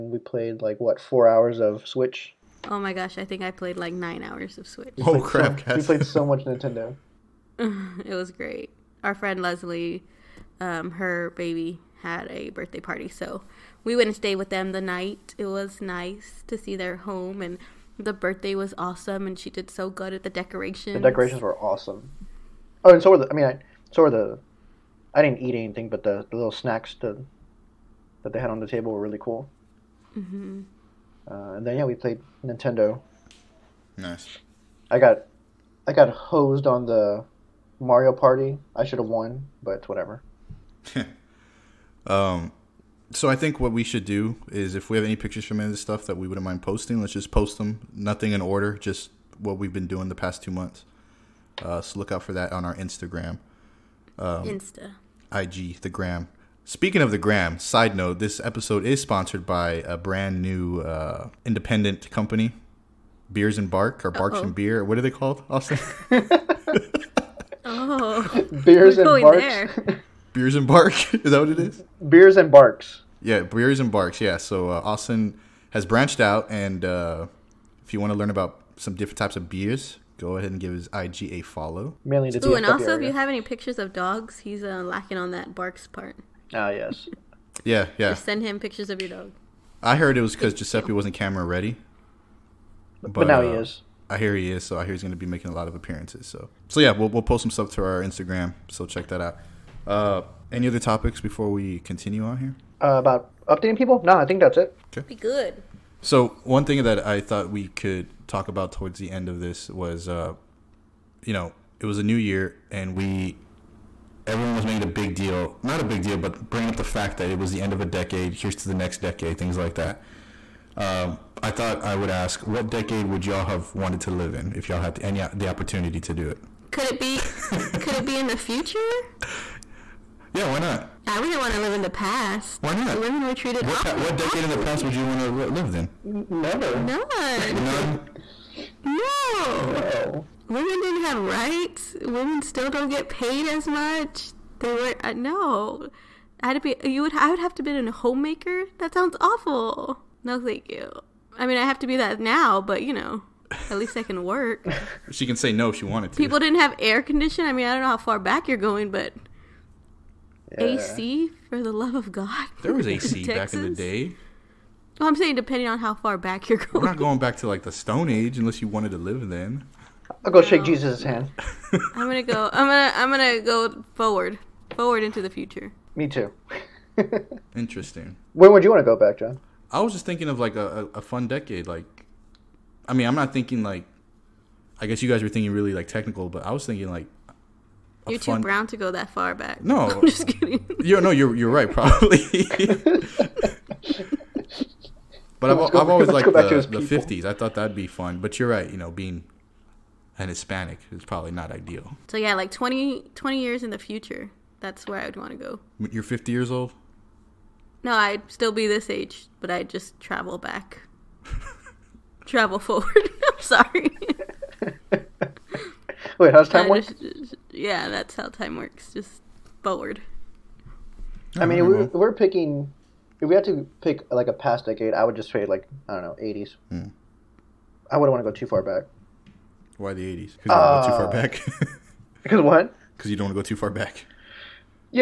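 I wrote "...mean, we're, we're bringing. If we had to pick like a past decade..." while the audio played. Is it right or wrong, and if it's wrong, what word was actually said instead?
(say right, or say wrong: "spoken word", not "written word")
wrong: "picking", not "bringing".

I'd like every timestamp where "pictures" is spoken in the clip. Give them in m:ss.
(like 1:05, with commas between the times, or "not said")
0:45, 1:23, 1:28.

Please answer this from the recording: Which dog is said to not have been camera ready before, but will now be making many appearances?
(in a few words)
Giuseppe.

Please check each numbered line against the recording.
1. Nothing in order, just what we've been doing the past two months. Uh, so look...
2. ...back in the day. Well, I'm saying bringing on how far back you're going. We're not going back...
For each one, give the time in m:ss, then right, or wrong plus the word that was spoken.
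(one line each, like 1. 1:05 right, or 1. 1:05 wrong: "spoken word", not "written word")
1. 0:47 right
2. 2:43 wrong: "depending", not "bringing".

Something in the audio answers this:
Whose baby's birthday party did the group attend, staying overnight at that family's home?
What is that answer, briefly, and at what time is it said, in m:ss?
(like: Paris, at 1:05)
Leslie, at 0:09.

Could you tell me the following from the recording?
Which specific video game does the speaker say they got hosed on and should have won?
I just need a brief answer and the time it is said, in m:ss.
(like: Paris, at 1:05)
Mario Party, at 0:37.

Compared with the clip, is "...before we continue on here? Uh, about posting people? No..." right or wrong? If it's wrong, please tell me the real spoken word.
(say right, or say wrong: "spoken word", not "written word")
wrong: "updating", not "posting".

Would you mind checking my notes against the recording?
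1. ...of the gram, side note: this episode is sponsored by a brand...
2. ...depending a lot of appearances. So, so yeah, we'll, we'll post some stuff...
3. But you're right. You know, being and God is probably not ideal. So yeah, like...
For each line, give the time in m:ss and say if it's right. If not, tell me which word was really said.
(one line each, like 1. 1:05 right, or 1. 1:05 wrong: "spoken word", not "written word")
1. 0:56 right
2. 1:35 wrong: "making", not "depending"
3. 3:18 wrong: "Hispanic", not "God".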